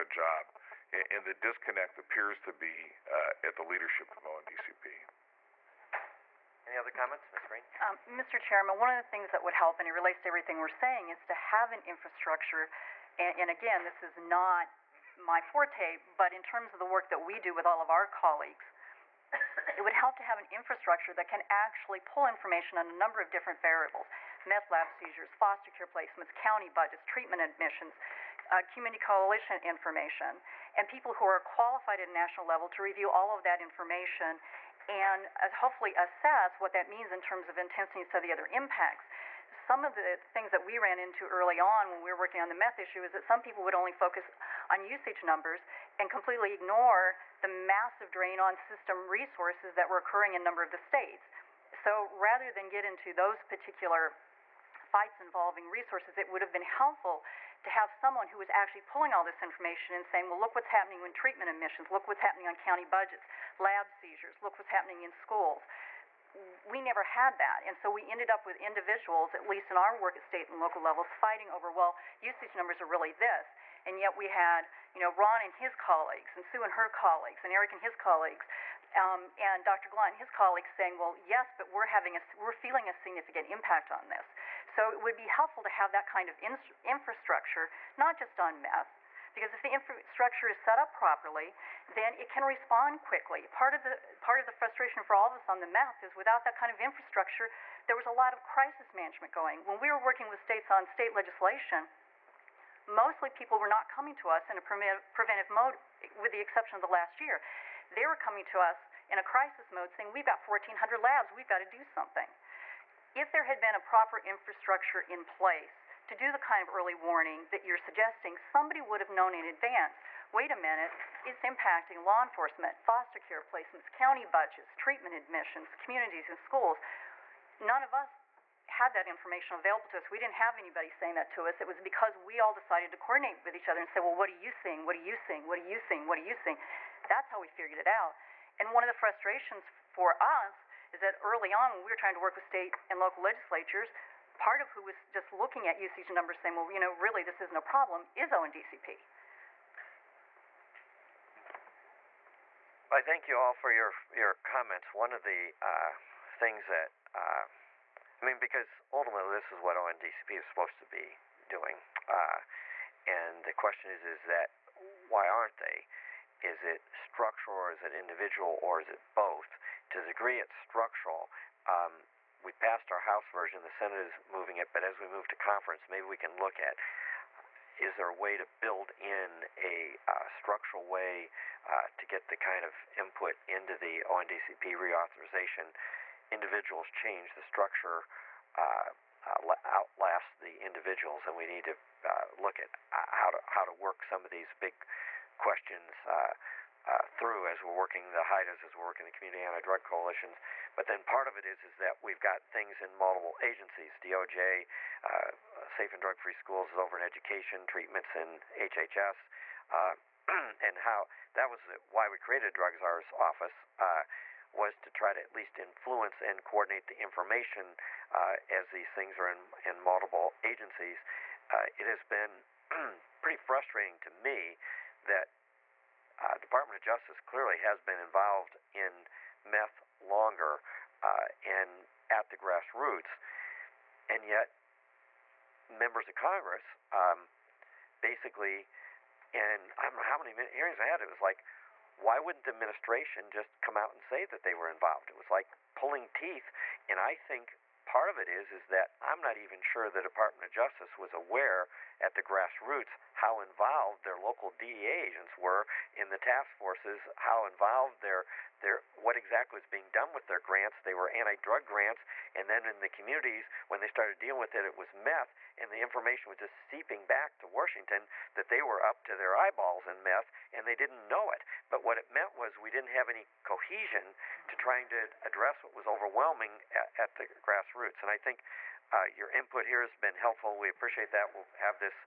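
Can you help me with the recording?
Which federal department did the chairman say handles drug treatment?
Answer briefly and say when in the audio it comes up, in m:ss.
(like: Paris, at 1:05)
HHS, at 3:28.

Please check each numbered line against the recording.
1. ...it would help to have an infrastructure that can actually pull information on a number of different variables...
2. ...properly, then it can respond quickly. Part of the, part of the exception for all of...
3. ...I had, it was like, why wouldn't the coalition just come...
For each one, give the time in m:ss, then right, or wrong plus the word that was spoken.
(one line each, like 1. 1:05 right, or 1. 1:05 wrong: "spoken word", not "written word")
1. 0:19 right
2. 1:30 wrong: "frustration", not "exception"
3. 4:00 wrong: "administration", not "coalition".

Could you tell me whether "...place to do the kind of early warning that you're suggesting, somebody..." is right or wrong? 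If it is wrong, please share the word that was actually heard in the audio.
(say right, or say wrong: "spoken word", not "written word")
right.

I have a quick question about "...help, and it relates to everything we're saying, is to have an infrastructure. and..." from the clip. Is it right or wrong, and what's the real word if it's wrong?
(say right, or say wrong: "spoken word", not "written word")
right.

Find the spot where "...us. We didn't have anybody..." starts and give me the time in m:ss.
2:09.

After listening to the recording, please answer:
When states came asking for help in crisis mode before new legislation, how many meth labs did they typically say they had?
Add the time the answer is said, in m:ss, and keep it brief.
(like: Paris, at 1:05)
1,400, at 1:50.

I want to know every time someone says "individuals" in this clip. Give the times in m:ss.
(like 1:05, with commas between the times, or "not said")
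1:08, 2:47, 3:06, 3:10.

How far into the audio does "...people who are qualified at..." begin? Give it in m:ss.
0:30.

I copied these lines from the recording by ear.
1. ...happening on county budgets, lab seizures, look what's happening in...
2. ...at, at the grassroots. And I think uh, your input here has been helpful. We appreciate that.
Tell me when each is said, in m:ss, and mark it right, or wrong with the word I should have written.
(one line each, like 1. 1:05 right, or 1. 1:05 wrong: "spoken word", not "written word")
1. 1:02 right
2. 4:36 right.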